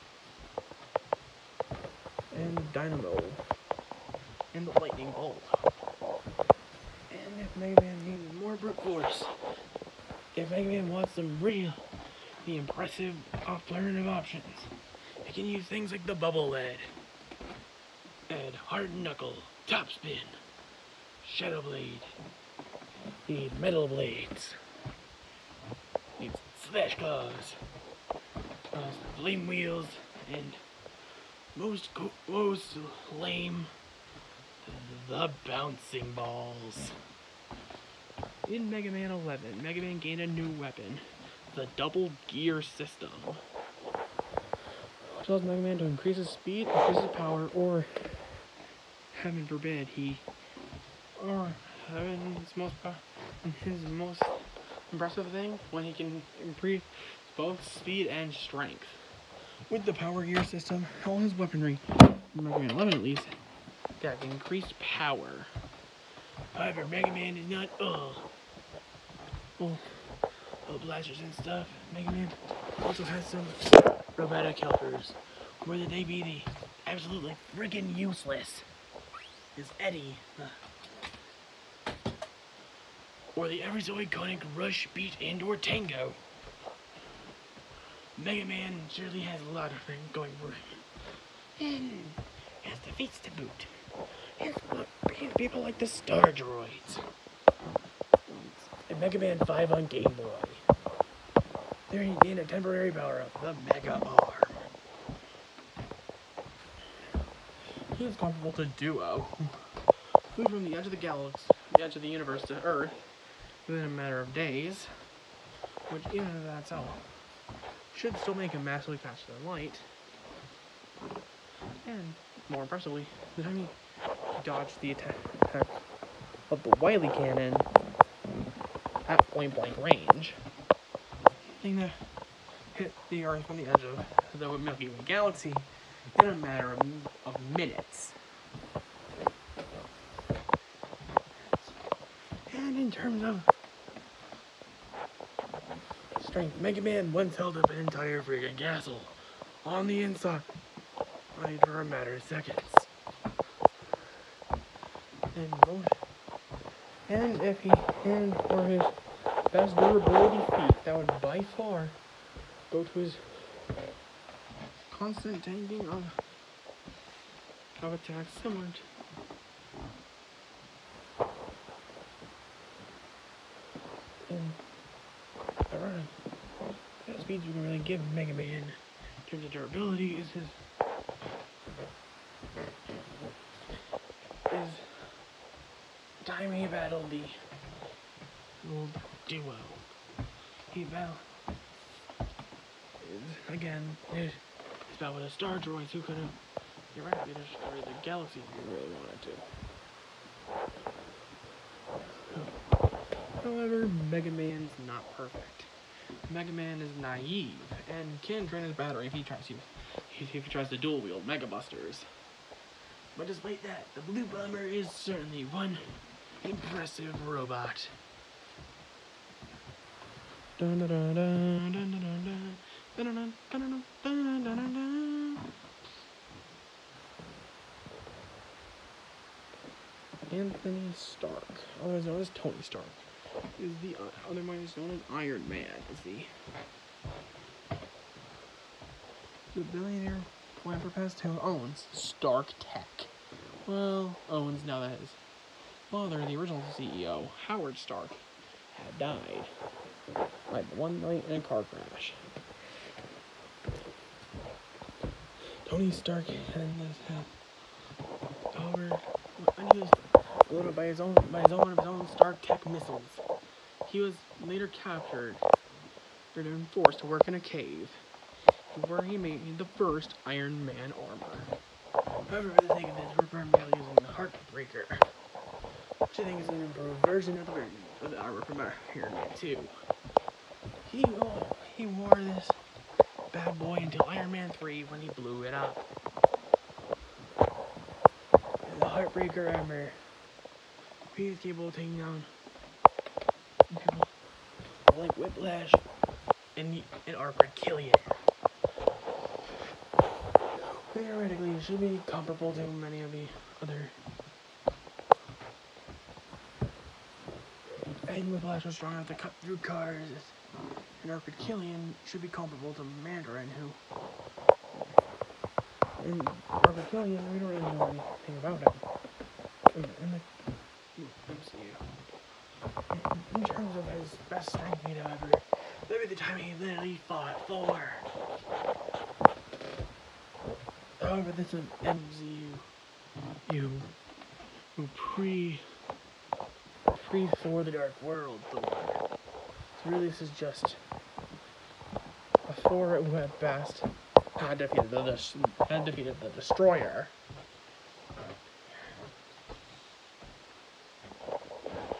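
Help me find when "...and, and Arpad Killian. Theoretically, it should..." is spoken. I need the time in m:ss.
4:56.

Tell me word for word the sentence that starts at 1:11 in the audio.
Mega Man also has some robotic helpers.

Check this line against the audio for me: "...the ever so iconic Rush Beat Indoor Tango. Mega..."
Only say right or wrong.
right.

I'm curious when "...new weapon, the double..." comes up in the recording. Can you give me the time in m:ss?
0:40.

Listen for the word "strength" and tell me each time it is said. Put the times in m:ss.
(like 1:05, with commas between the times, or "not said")
0:58, 2:26, 5:24.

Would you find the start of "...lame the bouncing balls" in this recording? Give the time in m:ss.
0:33.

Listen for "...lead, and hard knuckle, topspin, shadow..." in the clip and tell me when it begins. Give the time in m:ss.
0:16.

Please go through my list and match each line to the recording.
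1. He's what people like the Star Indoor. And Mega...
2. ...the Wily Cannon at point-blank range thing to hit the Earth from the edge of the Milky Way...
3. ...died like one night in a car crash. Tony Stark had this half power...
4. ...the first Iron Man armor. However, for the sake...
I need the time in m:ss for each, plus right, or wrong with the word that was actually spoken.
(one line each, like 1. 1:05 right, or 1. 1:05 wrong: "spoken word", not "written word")
1. 1:34 wrong: "Droids", not "Indoor"
2. 2:06 right
3. 4:08 right
4. 4:29 right.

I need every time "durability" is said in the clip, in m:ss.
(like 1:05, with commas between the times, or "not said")
2:39, 2:59.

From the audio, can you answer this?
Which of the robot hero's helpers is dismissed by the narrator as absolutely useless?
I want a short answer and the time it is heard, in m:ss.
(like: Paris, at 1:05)
Eddie, at 1:19.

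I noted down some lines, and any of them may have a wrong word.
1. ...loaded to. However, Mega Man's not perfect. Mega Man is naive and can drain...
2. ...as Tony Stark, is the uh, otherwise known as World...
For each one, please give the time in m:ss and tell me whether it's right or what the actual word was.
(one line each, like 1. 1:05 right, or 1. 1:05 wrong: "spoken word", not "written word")
1. 3:22 wrong: "wanted", not "loaded"
2. 3:52 wrong: "Iron", not "World".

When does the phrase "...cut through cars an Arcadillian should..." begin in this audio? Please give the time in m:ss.
5:09.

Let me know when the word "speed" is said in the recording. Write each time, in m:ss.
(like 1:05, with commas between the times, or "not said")
0:46, 0:57, 2:57.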